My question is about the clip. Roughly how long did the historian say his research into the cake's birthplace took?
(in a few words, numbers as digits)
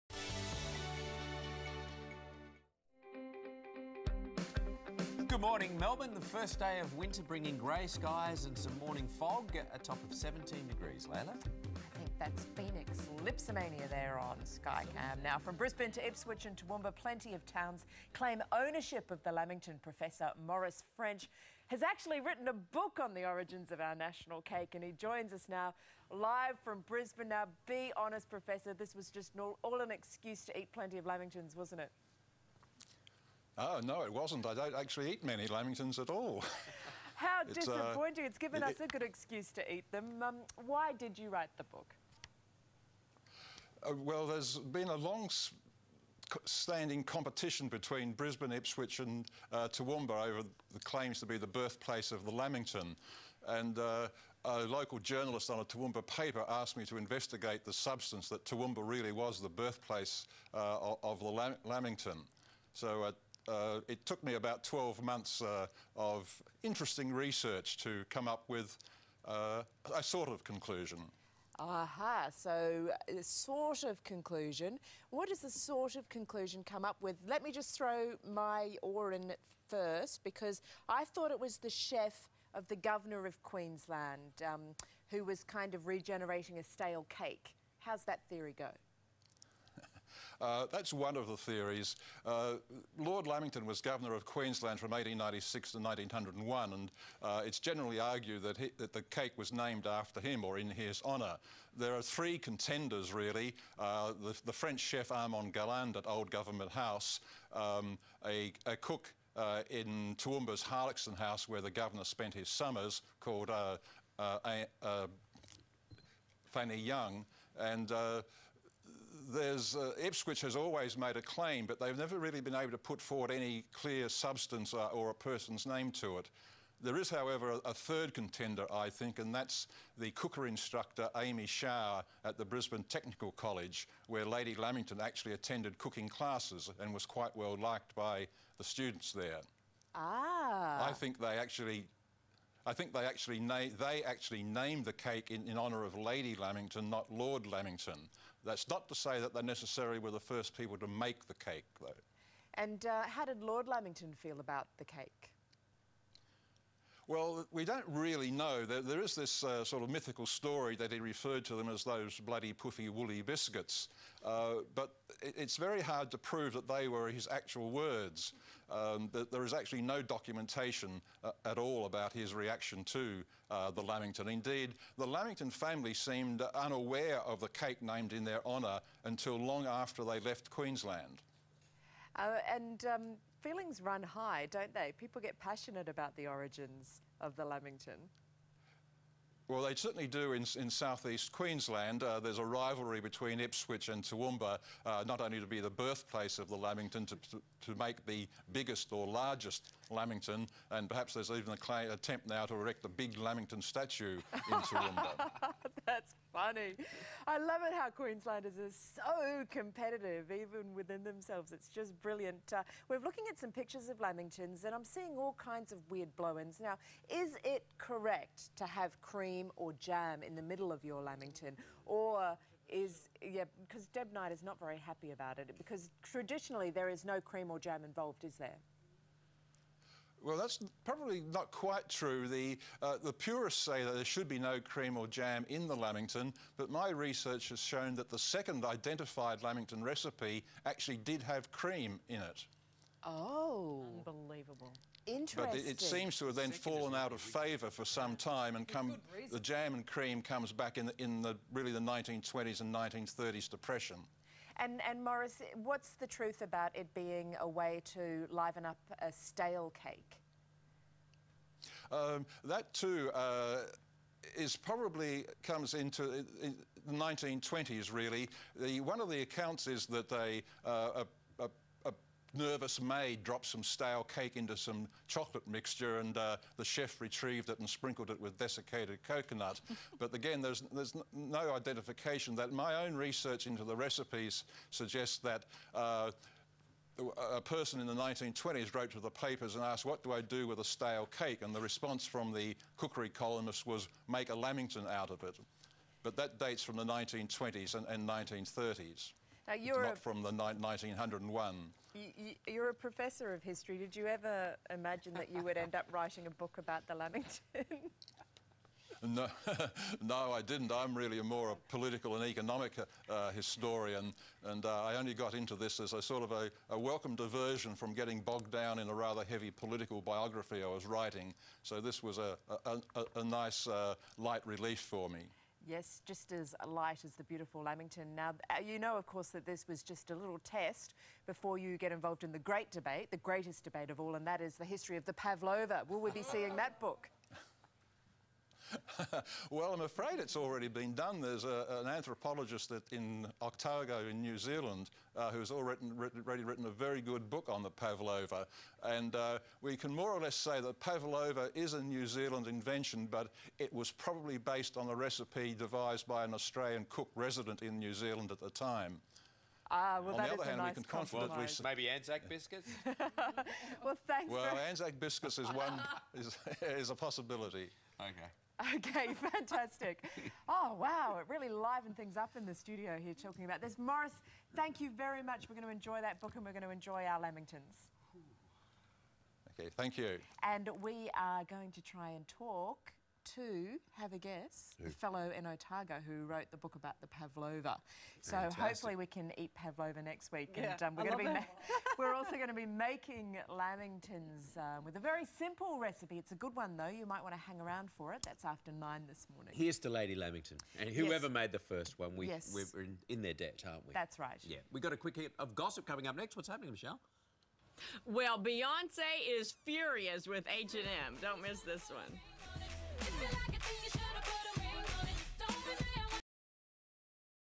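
12 months.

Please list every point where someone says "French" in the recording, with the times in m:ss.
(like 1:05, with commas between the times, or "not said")
0:20, 1:44.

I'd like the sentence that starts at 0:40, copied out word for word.
Um, why did you write the book?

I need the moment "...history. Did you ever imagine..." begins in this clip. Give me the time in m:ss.
5:03.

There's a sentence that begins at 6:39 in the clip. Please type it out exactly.
Here's to Lady Lamington, and whoever yes.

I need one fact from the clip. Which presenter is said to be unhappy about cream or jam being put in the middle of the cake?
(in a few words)
Deb Knight.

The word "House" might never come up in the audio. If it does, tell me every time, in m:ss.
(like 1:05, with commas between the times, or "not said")
1:46, 1:51.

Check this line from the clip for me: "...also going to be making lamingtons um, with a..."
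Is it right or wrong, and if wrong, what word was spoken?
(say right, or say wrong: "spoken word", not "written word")
right.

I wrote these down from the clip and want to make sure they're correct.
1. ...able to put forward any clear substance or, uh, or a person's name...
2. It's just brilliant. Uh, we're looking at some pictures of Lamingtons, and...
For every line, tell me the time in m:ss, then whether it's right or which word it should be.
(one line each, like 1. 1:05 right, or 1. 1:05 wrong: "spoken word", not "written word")
1. 2:02 right
2. 3:31 right.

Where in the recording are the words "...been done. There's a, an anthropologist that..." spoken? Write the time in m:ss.
5:40.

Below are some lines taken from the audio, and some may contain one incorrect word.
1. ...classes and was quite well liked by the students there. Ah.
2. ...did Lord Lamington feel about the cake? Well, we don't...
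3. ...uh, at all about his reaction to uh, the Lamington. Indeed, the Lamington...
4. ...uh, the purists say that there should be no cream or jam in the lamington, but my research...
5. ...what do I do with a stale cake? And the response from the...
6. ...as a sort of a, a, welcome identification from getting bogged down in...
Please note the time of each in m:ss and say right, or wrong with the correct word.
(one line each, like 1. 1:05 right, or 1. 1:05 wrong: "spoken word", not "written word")
1. 2:16 right
2. 2:33 right
3. 2:51 right
4. 3:52 right
5. 4:49 right
6. 5:15 wrong: "diversion", not "identification".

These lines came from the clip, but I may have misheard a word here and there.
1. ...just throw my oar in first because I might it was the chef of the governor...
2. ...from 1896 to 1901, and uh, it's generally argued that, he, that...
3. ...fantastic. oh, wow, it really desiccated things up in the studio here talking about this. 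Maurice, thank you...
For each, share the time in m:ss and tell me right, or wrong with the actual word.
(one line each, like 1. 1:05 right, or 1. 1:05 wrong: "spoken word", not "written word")
1. 1:17 wrong: "thought", not "might"
2. 1:34 right
3. 6:09 wrong: "livened", not "desiccated".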